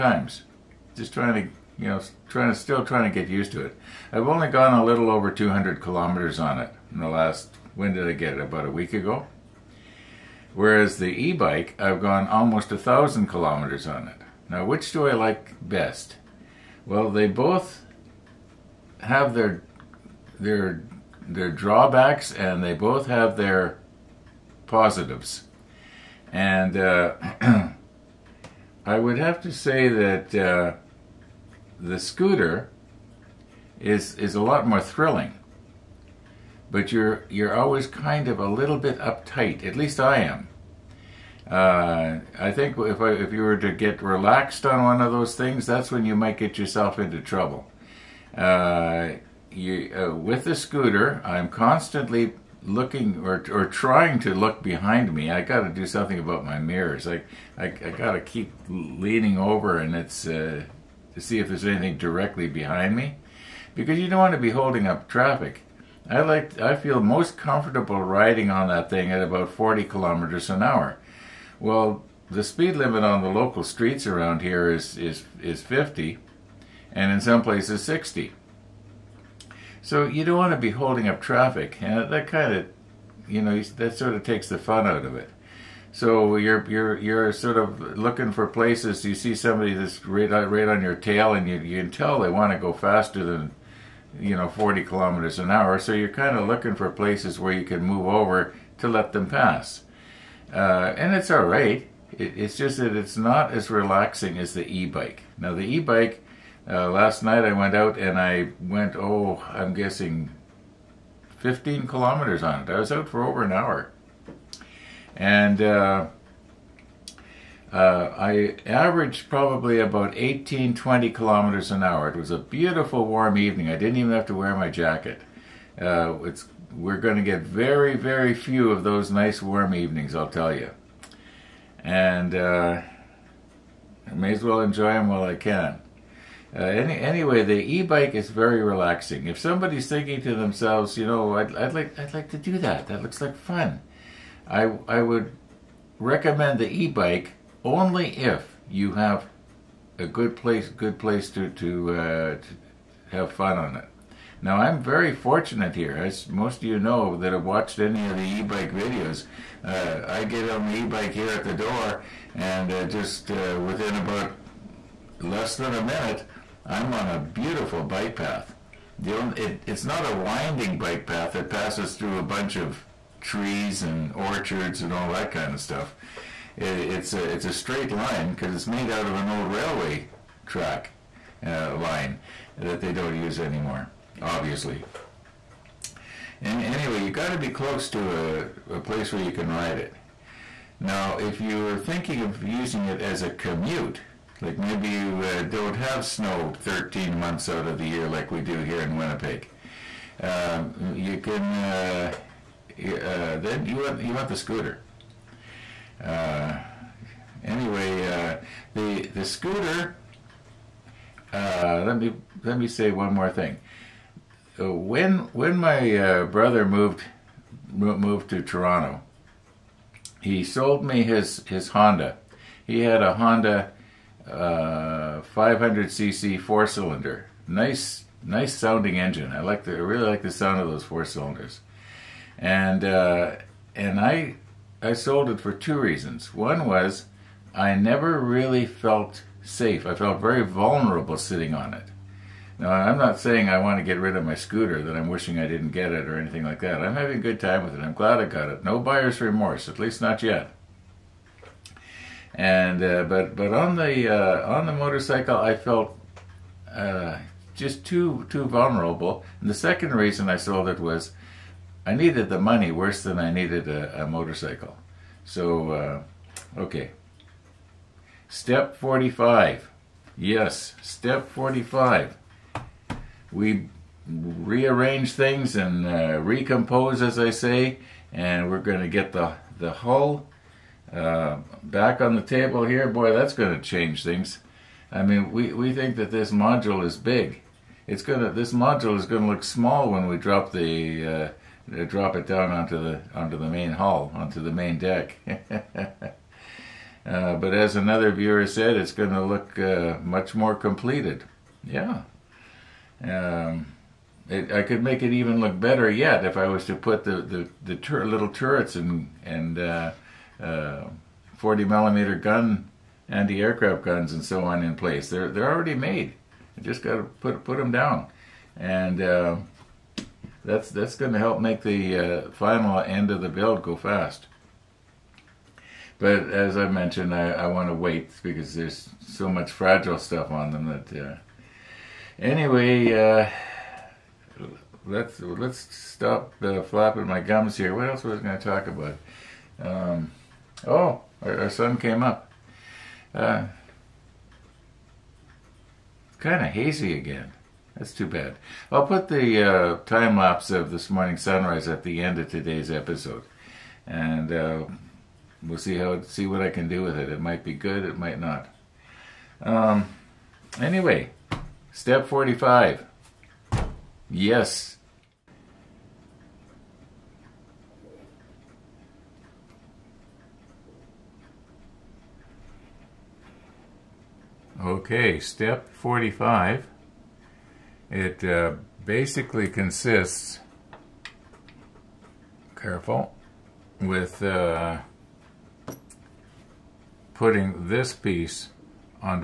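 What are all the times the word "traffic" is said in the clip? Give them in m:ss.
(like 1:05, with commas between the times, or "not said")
1:05, 1:21.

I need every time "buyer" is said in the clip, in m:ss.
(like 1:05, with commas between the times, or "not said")
4:08.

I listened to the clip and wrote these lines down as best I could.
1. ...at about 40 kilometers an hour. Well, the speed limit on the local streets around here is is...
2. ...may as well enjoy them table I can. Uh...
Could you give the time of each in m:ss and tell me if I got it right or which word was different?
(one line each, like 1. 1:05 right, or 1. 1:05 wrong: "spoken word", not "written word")
1. 1:09 right
2. 2:14 wrong: "while", not "table".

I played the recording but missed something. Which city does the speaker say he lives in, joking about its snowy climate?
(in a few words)
Winnipeg.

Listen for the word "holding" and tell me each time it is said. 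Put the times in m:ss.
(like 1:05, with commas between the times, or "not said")
1:04, 1:20.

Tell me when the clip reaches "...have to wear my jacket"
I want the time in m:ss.
2:04.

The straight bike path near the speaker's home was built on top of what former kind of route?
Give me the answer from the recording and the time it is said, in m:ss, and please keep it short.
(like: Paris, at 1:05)
railway track, at 2:59.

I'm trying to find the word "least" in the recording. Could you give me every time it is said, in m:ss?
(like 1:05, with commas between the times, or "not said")
0:39, 4:09.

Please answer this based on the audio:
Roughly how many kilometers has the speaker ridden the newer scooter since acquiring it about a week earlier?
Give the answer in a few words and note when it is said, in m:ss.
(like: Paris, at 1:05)
200, at 0:05.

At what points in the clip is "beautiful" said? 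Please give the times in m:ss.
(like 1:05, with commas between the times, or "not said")
2:02, 2:47.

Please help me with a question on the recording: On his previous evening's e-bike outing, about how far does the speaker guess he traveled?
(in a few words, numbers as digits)
15 kilometers.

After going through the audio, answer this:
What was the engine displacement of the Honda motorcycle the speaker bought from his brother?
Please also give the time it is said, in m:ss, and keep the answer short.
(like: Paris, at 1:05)
500cc, at 3:44.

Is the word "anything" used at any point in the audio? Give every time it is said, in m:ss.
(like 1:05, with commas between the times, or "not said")
1:01, 4:06.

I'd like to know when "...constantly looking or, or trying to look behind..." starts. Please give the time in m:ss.
0:51.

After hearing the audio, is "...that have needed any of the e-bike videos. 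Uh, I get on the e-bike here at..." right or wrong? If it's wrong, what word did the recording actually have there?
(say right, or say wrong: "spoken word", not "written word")
wrong: "watched", not "needed".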